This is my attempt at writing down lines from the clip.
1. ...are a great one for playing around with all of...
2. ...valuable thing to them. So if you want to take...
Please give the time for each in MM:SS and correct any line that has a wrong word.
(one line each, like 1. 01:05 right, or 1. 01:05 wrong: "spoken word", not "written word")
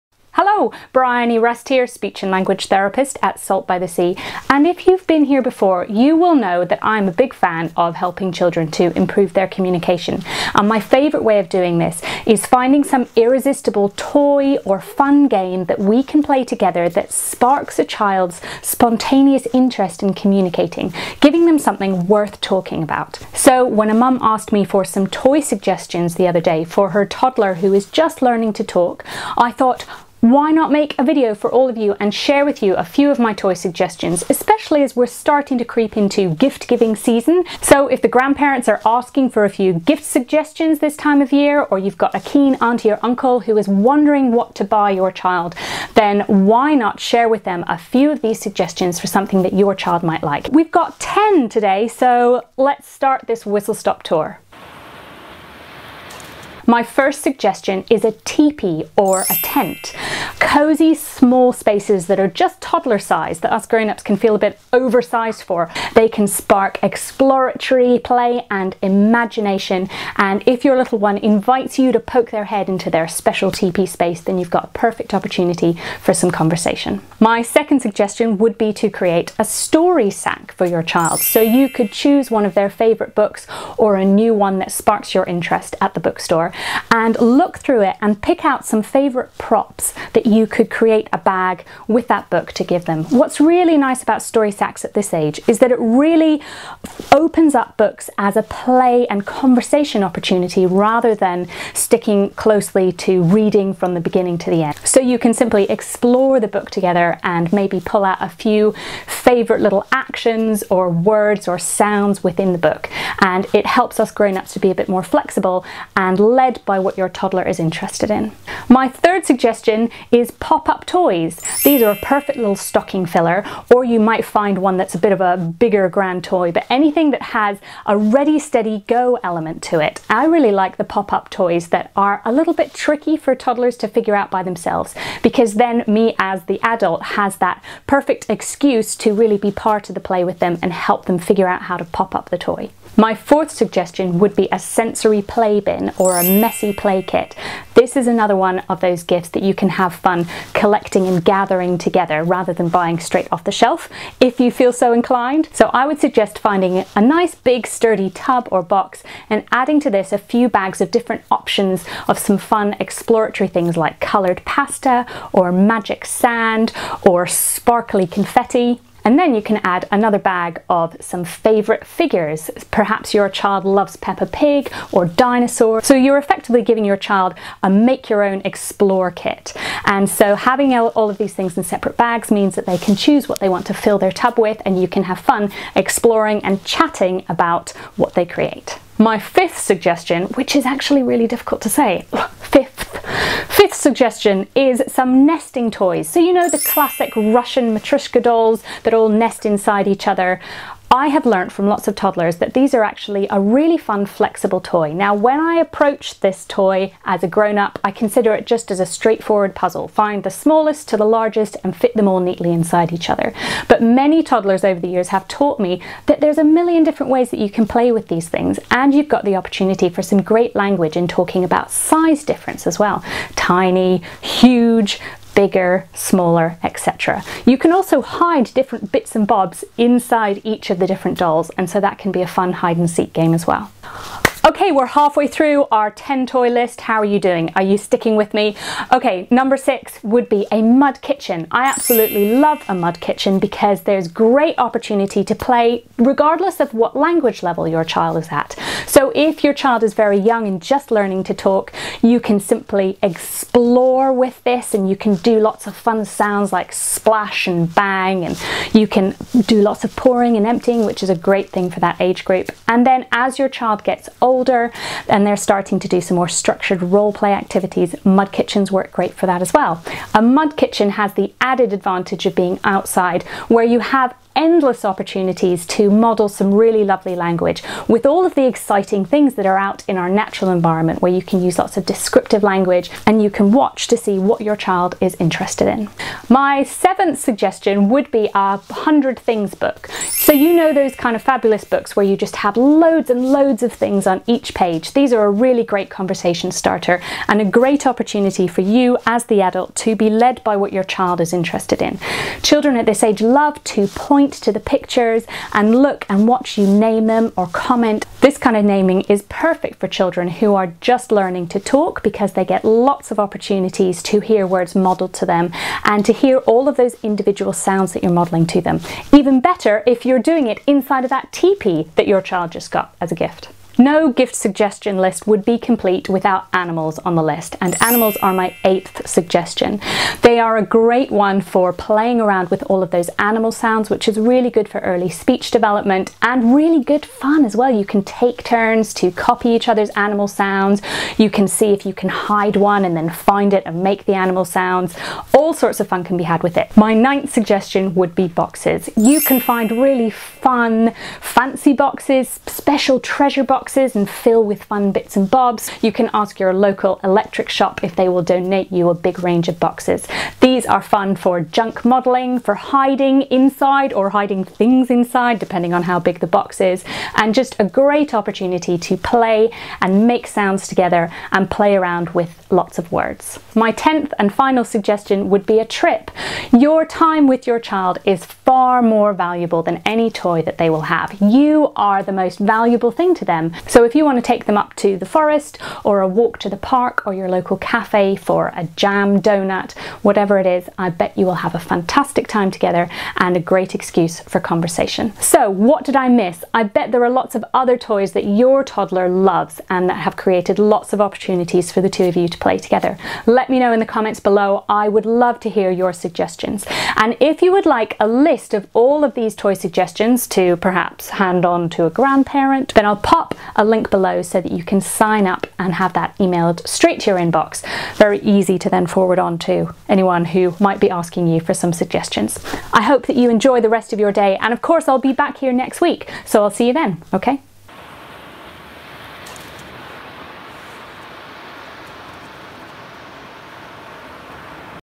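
1. 05:30 right
2. 06:22 right.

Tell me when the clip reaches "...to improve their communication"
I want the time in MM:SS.
00:08.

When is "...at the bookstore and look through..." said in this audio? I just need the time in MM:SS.
01:25.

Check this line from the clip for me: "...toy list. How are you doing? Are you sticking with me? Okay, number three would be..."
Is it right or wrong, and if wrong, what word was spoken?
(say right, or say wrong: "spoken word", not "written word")
wrong: "six", not "three".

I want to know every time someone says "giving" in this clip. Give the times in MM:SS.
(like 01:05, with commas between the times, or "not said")
00:21, 00:36, 02:56.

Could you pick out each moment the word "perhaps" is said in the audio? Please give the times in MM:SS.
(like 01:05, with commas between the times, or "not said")
02:52, 06:50.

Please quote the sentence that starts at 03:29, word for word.
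Find the smallest to the largest and fit them all neatly inside each other.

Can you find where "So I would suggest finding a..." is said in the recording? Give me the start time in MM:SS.
02:35.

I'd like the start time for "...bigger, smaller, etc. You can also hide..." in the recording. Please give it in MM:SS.
03:45.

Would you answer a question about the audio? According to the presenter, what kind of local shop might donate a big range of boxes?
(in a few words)
electric shop.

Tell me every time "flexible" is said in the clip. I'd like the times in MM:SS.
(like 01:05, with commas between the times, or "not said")
01:55, 03:24.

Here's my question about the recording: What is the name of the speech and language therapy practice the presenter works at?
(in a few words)
Salt by the Sea.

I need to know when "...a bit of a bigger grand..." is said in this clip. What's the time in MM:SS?
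02:04.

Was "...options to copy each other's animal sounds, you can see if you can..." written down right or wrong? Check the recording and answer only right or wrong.
wrong.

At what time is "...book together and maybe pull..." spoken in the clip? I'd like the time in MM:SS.
01:46.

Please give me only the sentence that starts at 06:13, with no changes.
My 10th and final suggestion would would be a trip.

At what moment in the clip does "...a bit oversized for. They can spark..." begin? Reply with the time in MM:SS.
01:04.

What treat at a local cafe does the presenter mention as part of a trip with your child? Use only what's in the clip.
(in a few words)
jam donut.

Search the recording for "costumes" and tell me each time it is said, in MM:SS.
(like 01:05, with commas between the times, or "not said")
not said.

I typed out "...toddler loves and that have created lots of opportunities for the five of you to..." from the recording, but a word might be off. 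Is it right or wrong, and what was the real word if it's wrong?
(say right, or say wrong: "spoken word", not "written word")
wrong: "two", not "five".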